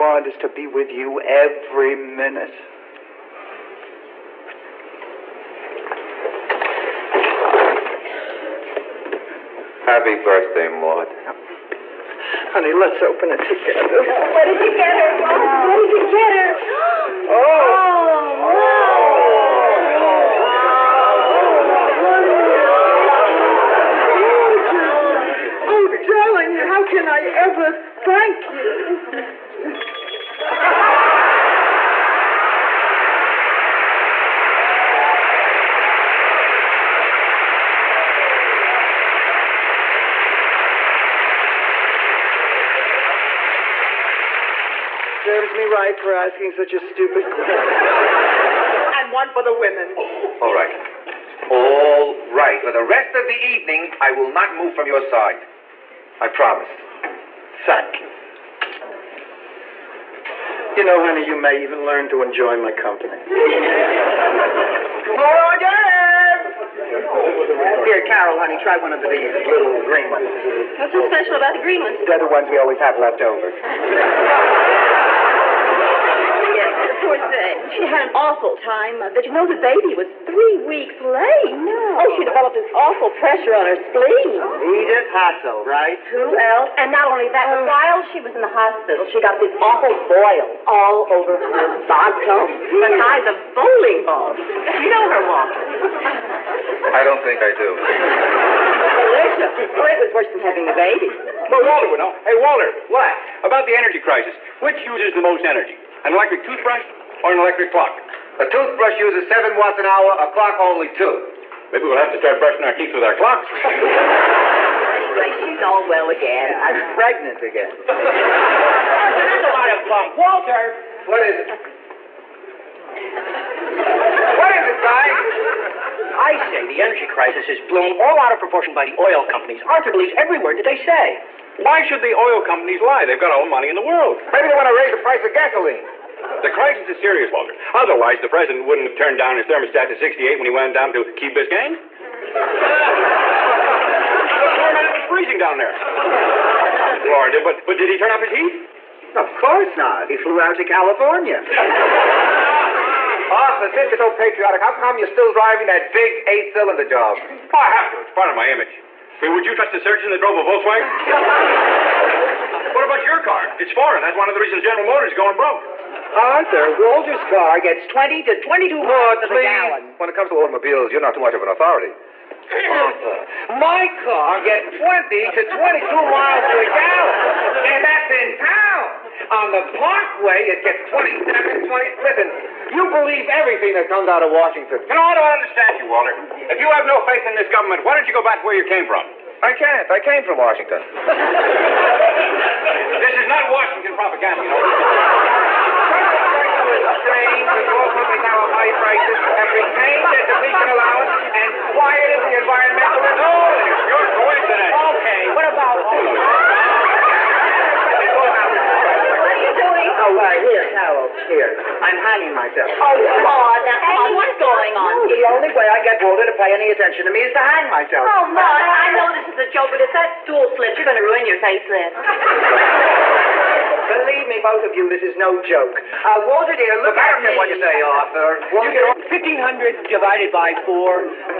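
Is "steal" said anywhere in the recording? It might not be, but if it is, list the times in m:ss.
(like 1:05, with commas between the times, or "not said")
not said.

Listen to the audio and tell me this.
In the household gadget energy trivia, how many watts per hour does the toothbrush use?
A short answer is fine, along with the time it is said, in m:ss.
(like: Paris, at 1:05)
7, at 1:49.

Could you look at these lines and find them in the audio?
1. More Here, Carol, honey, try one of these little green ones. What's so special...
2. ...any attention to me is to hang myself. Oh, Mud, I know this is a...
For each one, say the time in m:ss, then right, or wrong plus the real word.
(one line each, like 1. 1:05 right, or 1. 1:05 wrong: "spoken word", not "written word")
1. 1:05 right
2. 3:36 right.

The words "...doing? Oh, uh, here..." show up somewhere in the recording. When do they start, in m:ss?
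3:29.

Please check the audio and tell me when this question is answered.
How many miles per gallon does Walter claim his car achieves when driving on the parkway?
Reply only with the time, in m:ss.
3:00.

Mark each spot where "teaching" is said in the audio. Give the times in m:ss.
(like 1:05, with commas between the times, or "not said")
not said.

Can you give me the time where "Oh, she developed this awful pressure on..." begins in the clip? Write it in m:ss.
1:22.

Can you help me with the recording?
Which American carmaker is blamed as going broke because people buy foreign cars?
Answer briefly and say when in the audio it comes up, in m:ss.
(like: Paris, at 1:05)
General Motors, at 2:44.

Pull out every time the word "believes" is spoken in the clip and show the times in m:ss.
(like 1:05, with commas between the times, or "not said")
2:09, 3:02, 3:43.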